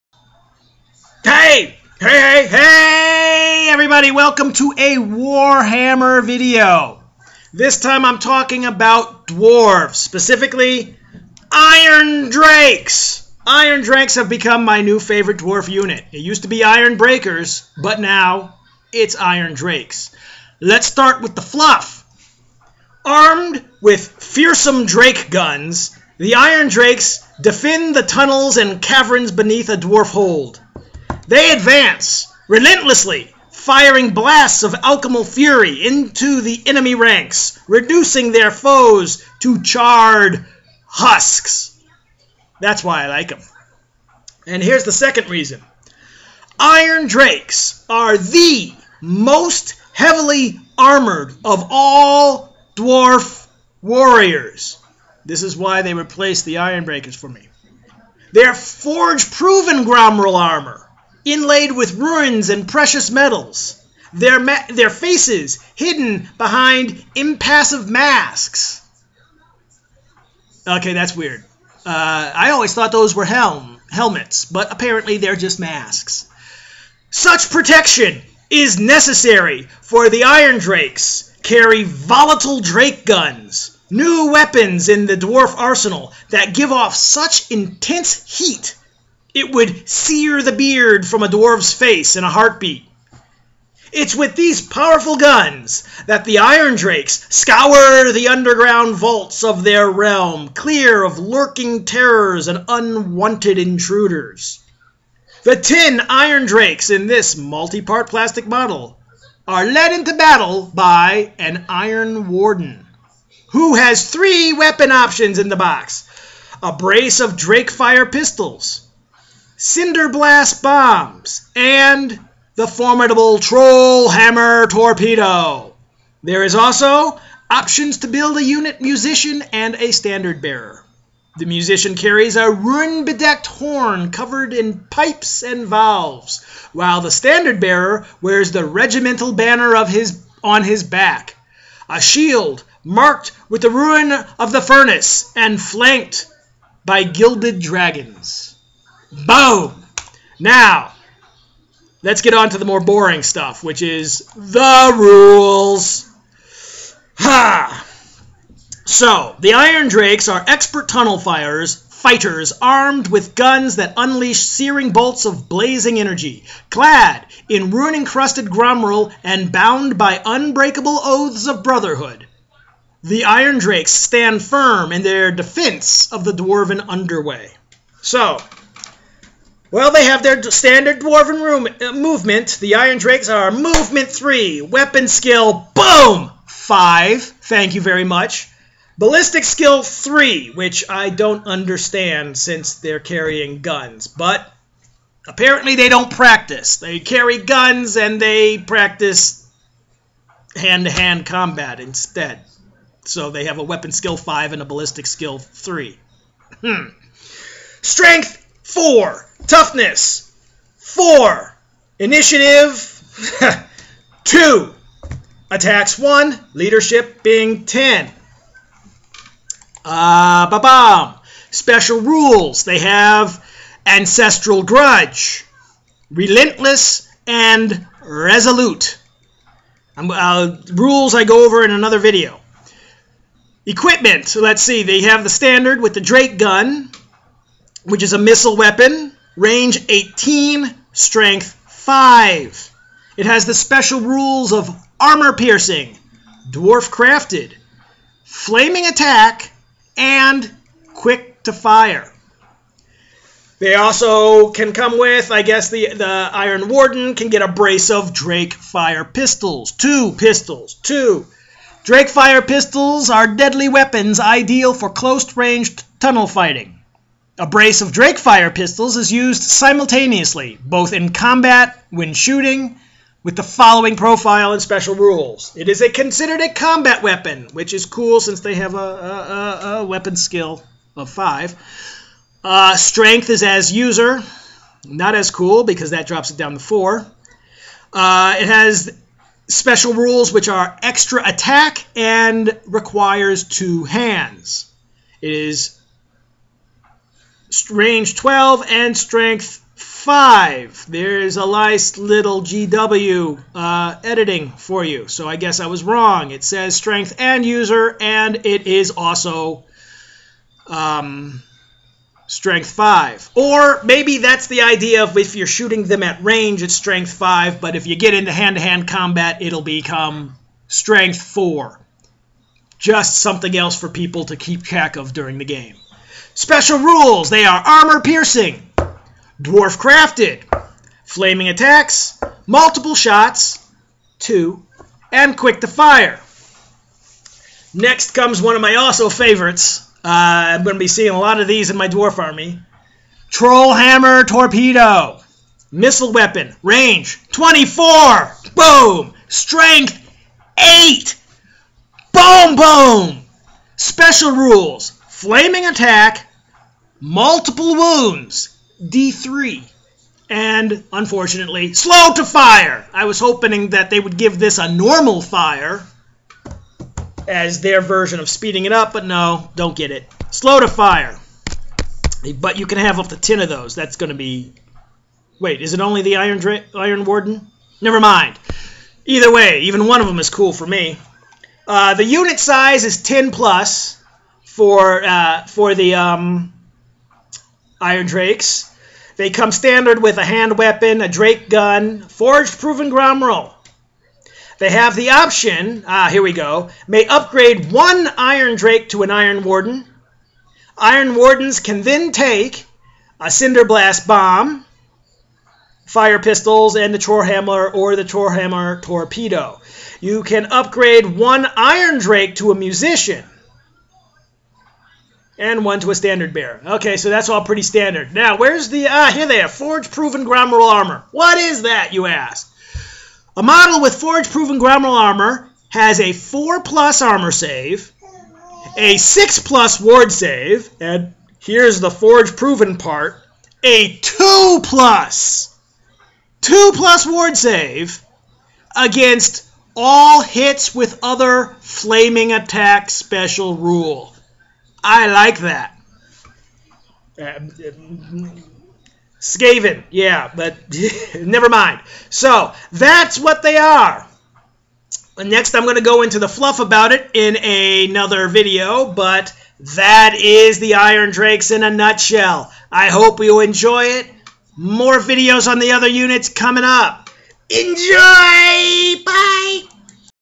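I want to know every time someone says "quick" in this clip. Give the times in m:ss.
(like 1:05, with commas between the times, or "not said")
4:10, 5:35.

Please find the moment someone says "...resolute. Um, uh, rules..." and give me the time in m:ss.
3:48.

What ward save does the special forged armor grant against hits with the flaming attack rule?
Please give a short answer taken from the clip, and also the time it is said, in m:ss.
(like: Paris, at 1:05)
2+, at 7:16.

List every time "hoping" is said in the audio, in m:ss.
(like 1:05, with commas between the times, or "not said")
6:03.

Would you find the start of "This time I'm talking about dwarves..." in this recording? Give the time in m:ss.
0:07.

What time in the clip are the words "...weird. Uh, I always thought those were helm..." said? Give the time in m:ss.
1:11.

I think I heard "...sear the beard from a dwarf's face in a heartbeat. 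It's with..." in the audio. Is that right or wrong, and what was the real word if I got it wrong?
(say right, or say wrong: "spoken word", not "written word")
right.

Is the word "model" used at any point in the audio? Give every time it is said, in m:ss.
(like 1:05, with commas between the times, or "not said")
1:48, 7:03.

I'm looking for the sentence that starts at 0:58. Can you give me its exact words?
They're forge-proven Gromril armor inlaid with runes and precious metals, their, ma- their faces hidden behind impassive masks.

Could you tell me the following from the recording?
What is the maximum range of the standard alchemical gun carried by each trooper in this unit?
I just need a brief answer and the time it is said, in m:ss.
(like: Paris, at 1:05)
18, at 3:59.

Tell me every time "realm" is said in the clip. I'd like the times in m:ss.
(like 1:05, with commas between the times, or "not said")
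1:39.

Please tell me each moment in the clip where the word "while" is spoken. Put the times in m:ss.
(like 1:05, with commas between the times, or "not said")
2:16.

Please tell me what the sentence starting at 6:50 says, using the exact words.
You can upgrade one Iron Drake to a Musician and one to a standard bearer.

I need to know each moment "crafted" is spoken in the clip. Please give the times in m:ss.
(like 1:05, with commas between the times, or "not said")
4:06, 5:29.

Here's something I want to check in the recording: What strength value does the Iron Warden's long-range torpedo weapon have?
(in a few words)
8.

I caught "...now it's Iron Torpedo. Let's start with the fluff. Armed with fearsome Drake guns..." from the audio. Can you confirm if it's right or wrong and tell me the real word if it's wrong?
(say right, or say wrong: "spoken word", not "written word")
wrong: "Drakes", not "Torpedo".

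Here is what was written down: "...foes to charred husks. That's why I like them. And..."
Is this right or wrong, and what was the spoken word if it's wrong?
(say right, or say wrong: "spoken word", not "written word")
right.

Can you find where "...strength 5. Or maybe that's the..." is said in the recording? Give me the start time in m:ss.
5:12.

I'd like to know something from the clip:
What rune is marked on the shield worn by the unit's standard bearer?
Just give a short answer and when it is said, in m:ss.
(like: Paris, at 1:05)
rune of the furnace, at 2:23.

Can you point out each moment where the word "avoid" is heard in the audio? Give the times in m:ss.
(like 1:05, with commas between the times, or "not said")
not said.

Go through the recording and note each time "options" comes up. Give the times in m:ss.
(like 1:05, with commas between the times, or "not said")
1:54, 2:07, 6:35.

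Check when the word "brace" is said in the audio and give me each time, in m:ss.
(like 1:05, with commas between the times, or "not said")
1:56, 4:17, 4:27.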